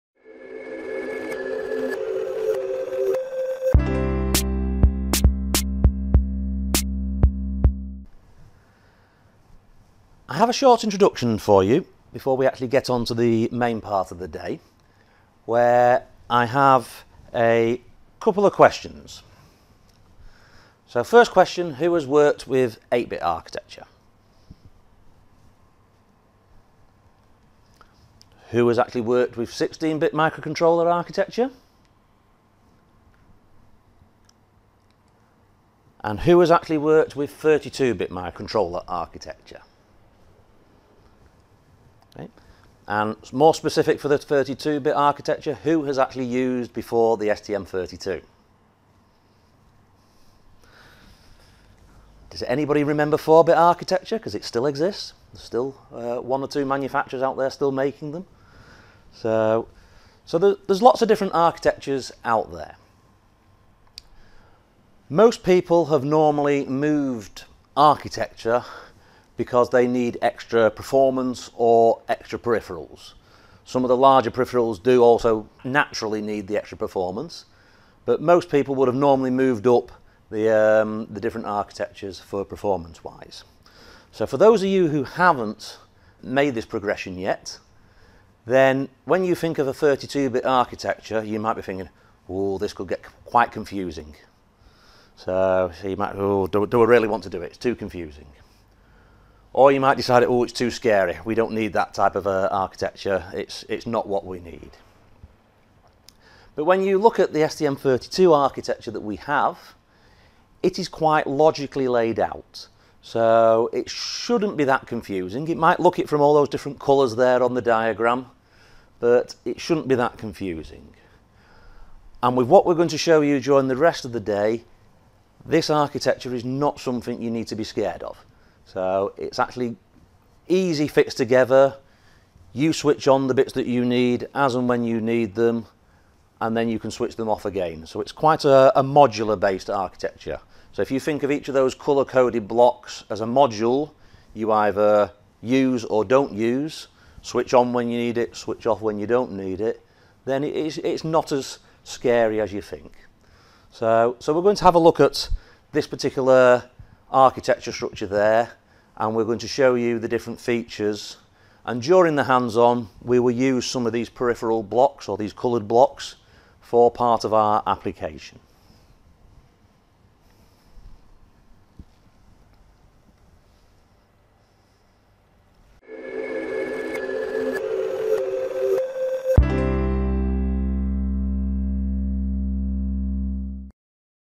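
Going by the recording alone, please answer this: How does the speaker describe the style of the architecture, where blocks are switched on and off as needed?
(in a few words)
Modular based.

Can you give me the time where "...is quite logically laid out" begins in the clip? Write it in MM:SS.
01:50.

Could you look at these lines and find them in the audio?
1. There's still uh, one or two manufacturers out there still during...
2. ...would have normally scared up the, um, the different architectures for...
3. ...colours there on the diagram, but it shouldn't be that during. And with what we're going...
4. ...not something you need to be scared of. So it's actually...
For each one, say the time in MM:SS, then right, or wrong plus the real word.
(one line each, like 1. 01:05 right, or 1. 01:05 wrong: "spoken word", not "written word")
1. 00:55 wrong: "making", not "during"
2. 01:18 wrong: "moved", not "scared"
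3. 01:56 wrong: "confusing", not "during"
4. 02:06 right.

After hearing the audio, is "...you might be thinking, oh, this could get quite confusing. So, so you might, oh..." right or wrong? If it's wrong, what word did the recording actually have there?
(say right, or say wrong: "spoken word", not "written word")
right.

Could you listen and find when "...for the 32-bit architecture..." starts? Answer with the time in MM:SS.
00:43.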